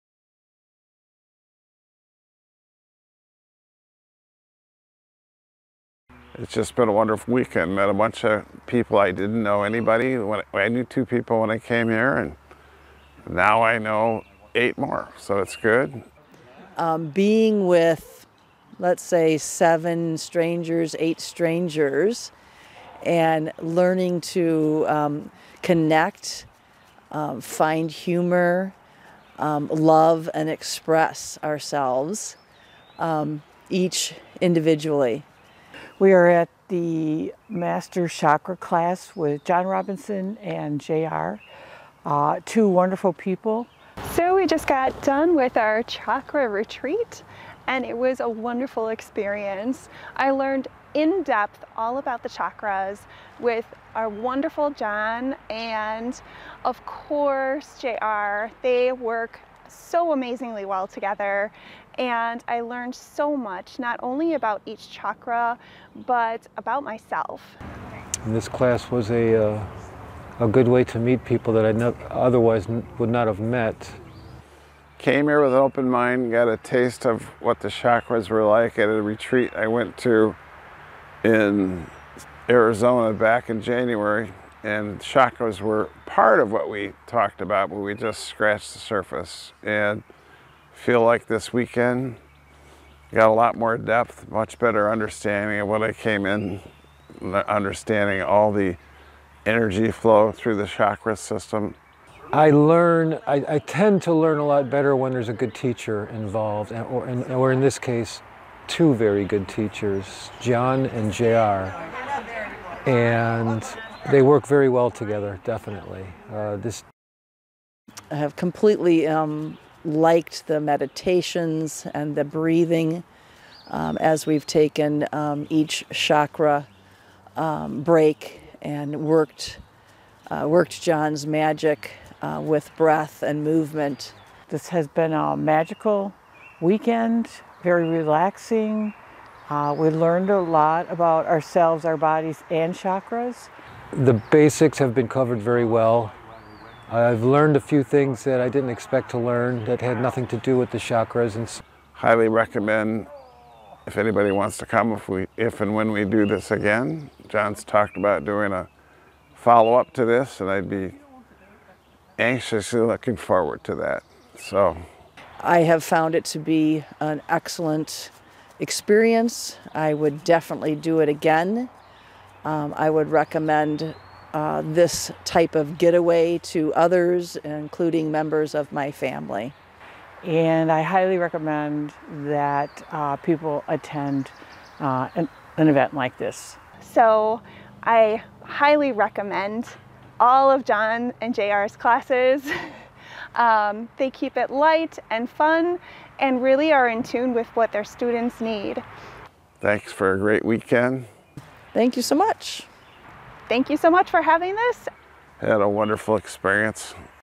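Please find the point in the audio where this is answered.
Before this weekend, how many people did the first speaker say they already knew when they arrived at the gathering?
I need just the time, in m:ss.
0:10.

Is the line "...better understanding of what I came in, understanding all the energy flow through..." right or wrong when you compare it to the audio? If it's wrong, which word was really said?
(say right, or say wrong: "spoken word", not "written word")
right.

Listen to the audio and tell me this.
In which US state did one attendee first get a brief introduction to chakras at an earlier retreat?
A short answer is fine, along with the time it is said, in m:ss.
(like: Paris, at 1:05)
Arizona, at 1:22.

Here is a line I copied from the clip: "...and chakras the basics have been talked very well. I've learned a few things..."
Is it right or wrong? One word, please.
wrong.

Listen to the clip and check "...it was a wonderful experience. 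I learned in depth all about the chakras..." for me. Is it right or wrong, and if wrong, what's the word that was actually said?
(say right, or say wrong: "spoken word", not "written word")
right.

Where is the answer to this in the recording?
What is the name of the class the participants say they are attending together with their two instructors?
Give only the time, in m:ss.
0:36.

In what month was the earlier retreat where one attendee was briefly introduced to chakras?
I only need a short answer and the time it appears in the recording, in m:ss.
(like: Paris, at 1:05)
January, at 1:23.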